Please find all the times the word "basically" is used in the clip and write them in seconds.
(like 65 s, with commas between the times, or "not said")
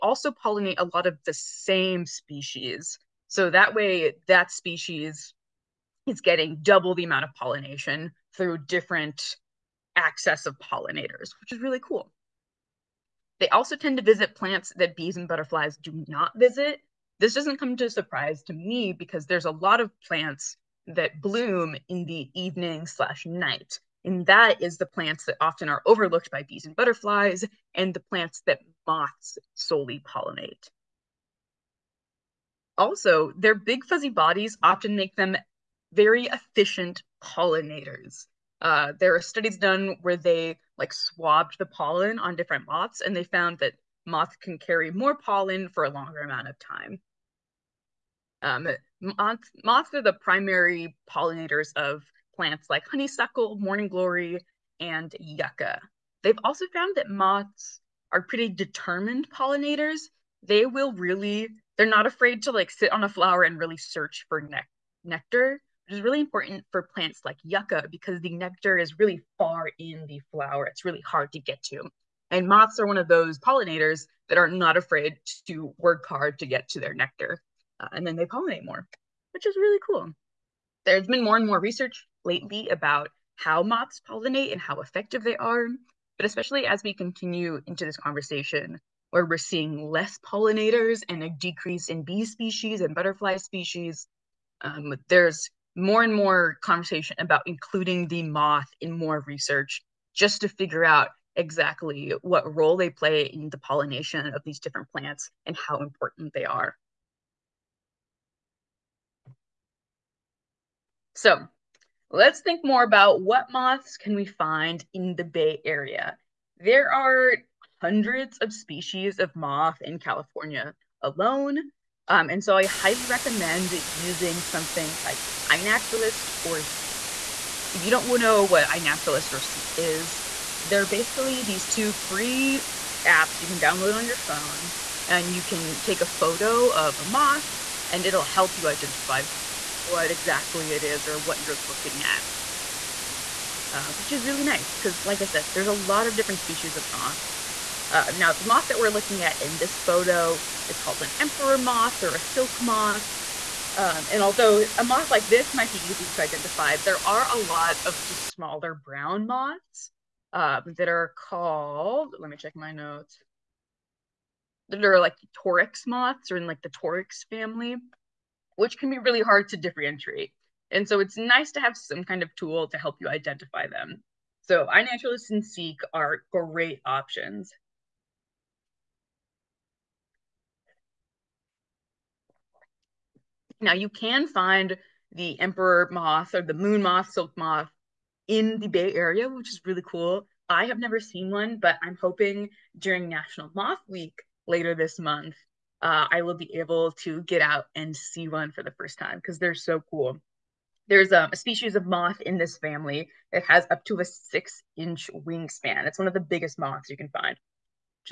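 130 s.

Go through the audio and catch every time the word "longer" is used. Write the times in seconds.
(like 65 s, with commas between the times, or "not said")
45 s.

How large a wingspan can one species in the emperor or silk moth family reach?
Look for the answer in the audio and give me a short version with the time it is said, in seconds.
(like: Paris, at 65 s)
6 inches, at 204 s.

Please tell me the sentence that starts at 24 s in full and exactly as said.
And that is the plants that often are overlooked by bees and butterflies, and the plants that moths solely pollinate.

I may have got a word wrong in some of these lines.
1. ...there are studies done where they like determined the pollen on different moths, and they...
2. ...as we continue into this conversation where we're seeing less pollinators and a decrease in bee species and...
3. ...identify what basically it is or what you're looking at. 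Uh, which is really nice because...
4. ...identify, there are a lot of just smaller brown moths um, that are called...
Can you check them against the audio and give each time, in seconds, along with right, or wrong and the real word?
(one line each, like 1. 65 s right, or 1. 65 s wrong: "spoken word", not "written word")
1. 38 s wrong: "swabbed", not "determined"
2. 86 s right
3. 138 s wrong: "exactly", not "basically"
4. 156 s right.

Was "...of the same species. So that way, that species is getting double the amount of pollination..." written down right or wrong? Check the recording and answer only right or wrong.
right.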